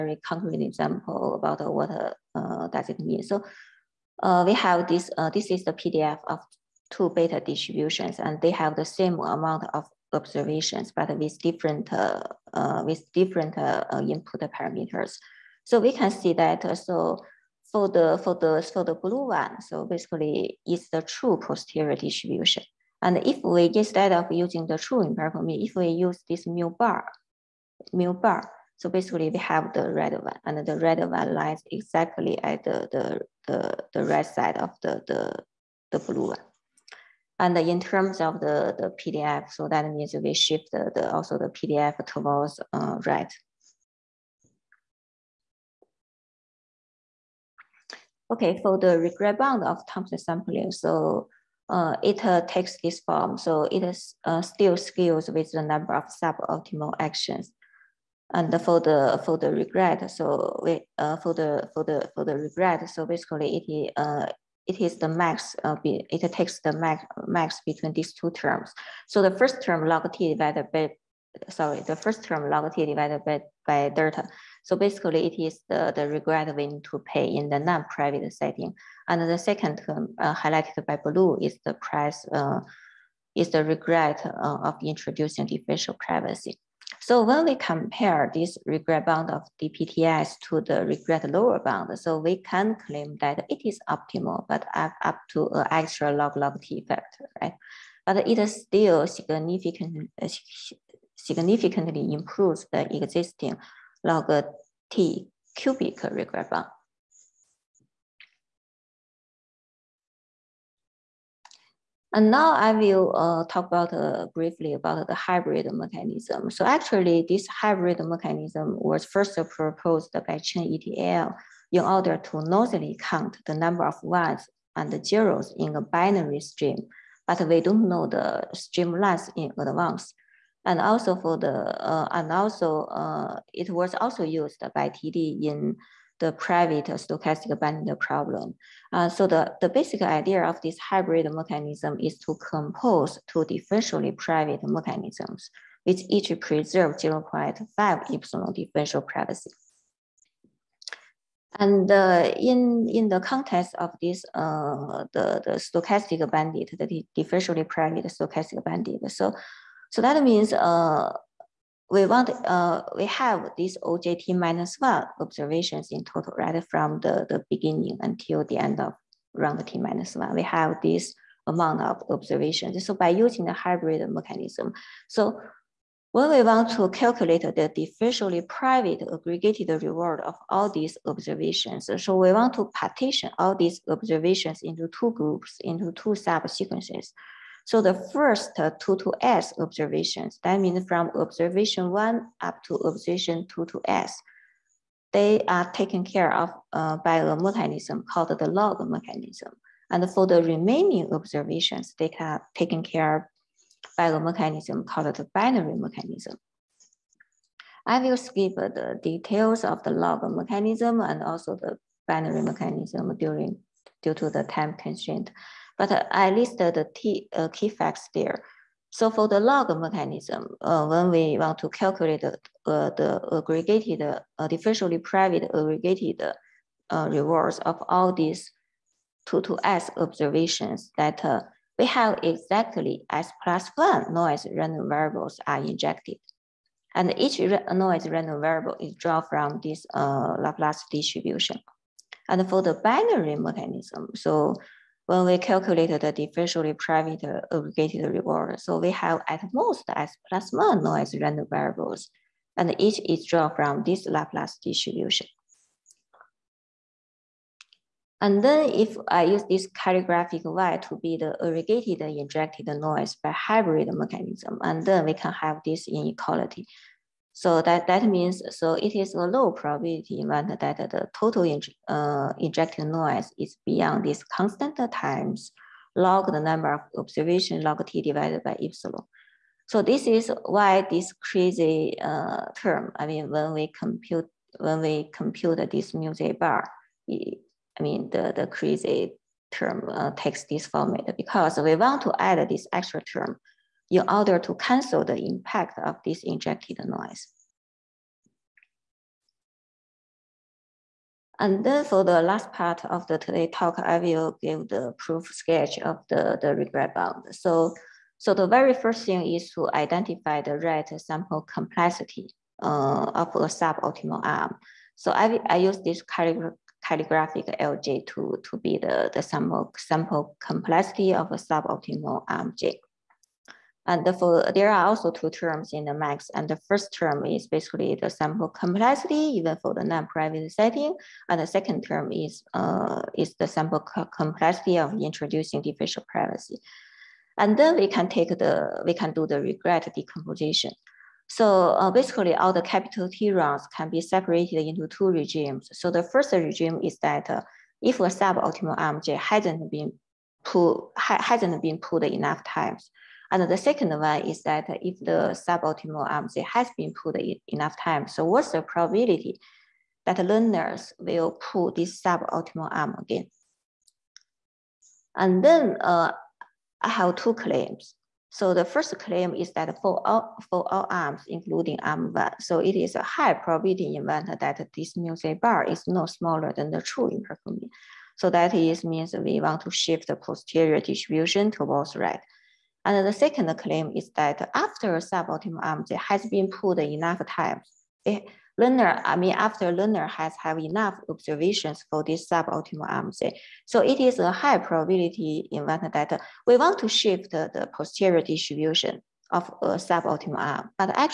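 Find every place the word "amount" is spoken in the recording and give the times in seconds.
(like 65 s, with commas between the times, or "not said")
9 s, 171 s.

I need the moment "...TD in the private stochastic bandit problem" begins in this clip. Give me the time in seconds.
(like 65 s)
134 s.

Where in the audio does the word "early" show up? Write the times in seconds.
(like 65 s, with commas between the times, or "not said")
not said.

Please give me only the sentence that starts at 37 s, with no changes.
And in terms of the, the PDF, so that means we shift the, the also the PDF towards uh, right.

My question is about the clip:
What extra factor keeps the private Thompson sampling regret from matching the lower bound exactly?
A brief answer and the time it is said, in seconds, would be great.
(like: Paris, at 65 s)
log-log t, at 96 s.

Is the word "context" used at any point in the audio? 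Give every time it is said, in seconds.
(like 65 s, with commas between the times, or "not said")
153 s.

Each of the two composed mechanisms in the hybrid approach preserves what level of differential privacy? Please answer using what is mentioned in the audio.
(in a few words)
0.5 epsilon.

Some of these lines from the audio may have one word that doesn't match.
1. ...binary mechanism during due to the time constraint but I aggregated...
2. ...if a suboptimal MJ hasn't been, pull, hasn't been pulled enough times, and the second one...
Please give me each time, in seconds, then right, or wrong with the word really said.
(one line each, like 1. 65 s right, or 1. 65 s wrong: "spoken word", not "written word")
1. 212 s wrong: "listed", not "aggregated"
2. 347 s right.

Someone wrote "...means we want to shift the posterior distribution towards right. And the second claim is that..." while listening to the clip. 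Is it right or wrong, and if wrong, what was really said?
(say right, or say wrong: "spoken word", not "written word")
right.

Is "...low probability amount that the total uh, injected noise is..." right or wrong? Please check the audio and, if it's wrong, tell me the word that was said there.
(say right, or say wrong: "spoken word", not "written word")
wrong: "event", not "amount".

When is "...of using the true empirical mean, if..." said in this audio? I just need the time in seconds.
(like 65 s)
24 s.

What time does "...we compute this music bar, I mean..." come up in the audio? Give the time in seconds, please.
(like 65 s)
284 s.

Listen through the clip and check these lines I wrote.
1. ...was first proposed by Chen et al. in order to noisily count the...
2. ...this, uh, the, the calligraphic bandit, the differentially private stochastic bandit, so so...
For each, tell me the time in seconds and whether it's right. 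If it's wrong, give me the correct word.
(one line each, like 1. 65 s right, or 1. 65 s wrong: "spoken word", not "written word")
1. 118 s right
2. 154 s wrong: "stochastic", not "calligraphic".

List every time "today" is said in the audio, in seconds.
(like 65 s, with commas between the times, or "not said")
303 s.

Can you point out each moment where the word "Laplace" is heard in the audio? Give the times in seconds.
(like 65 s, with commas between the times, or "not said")
240 s, 254 s.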